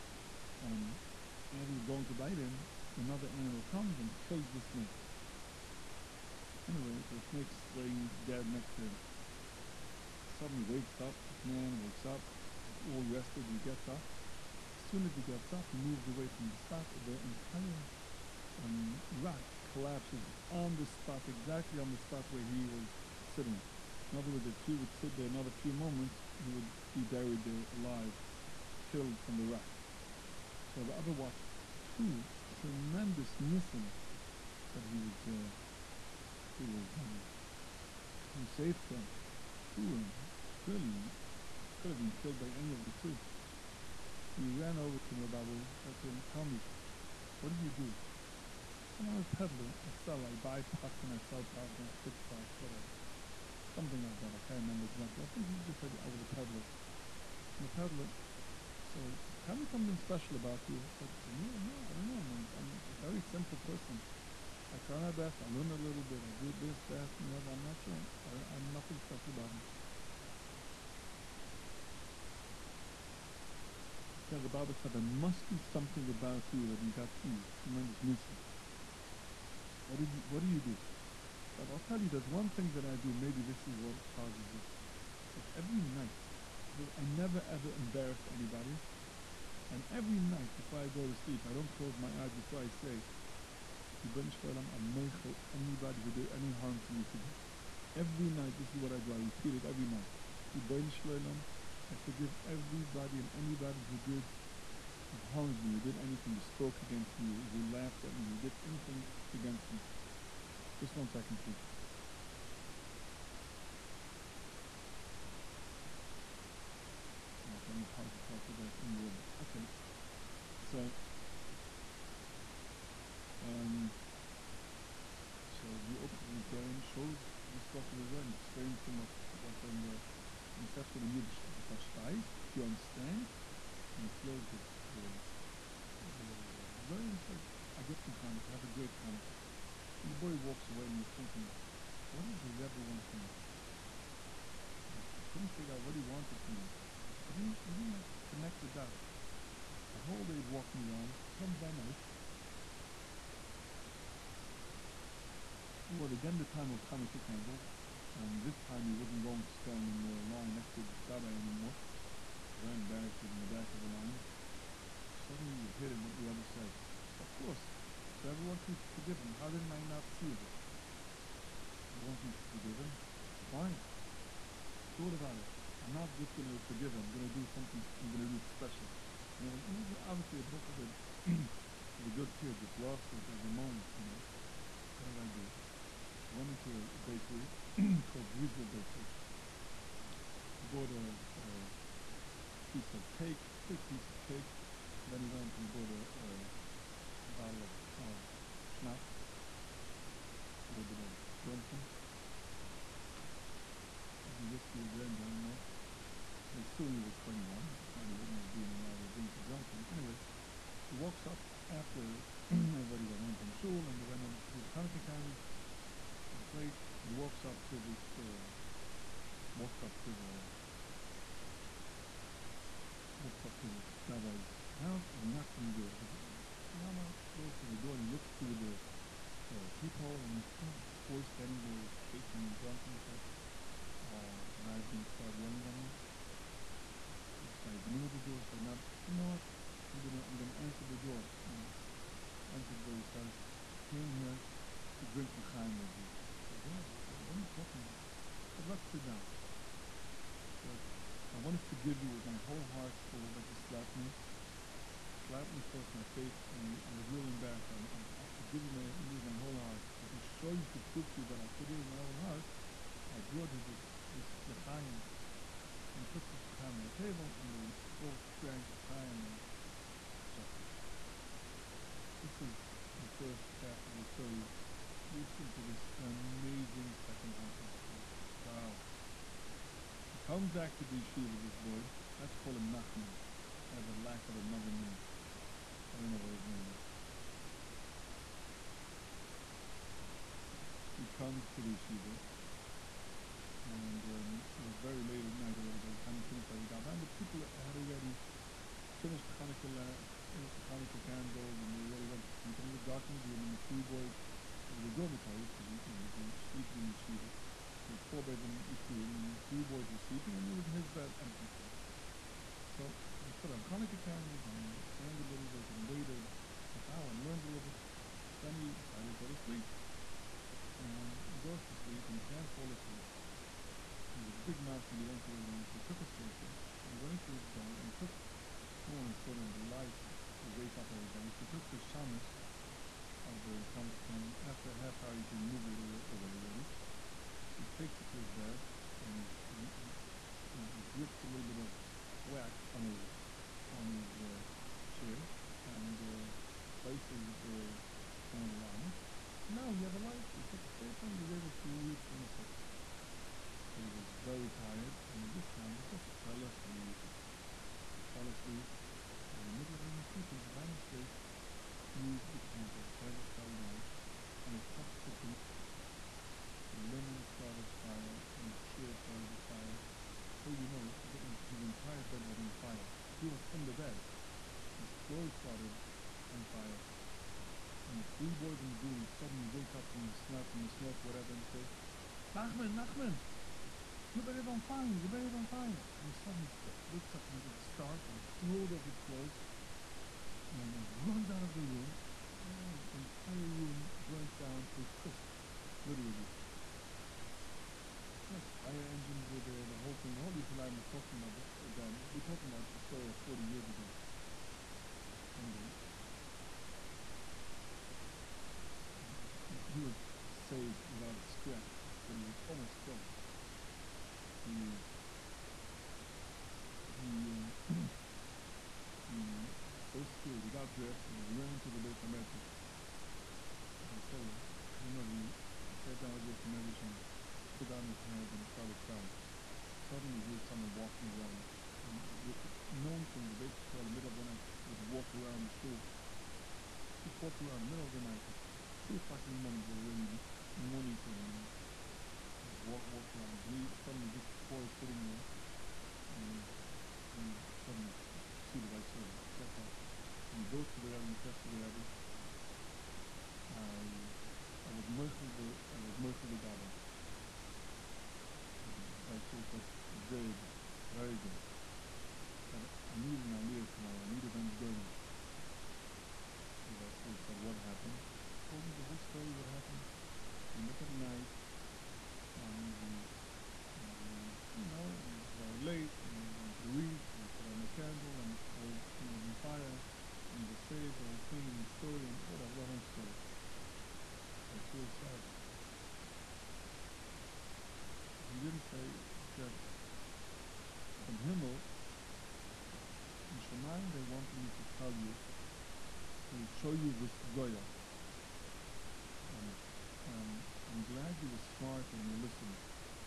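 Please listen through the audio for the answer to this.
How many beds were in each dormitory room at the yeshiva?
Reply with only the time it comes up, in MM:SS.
05:08.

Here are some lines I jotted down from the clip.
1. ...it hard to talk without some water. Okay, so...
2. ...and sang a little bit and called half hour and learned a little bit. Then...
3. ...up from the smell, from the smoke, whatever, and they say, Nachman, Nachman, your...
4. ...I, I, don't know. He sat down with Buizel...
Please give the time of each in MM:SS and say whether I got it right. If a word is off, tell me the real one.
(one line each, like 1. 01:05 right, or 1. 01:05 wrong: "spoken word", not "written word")
1. 01:57 right
2. 05:14 wrong: "waited", not "called"
3. 06:19 right
4. 07:04 wrong: "Beis", not "Buizel".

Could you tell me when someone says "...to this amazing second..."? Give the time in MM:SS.
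04:35.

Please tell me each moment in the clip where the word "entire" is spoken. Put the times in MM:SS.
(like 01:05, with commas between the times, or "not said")
00:17, 06:11, 06:33.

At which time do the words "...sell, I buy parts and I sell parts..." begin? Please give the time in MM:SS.
00:50.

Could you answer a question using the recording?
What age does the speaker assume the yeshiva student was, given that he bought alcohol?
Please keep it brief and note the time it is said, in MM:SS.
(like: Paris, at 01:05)
21, at 03:27.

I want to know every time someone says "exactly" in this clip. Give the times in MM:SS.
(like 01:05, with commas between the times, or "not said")
00:21, 00:54.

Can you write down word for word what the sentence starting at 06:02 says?
The candle fell down, and it touched his limb.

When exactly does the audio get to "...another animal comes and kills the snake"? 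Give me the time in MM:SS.
00:02.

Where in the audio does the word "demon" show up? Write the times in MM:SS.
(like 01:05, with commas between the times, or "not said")
not said.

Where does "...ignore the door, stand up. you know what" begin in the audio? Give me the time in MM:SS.
03:57.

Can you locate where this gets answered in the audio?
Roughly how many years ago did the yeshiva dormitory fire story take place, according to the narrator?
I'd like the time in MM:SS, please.
06:43.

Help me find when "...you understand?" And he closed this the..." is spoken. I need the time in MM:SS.
02:11.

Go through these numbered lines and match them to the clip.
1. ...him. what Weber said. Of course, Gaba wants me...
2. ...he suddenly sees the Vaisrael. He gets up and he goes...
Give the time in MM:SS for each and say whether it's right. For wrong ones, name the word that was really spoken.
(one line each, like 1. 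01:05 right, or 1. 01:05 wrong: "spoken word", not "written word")
1. 02:45 wrong: "Weber", not "Gaba"
2. 07:27 right.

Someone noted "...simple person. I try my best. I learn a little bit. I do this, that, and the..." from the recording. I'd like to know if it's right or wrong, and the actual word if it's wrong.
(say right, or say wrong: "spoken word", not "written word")
right.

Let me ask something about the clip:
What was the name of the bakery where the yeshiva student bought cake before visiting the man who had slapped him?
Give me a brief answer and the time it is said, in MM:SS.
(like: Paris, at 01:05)
Buizel Bakery, at 03:08.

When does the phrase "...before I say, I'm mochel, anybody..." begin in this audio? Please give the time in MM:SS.
01:32.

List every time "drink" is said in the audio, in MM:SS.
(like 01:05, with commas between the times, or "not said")
03:29, 04:05.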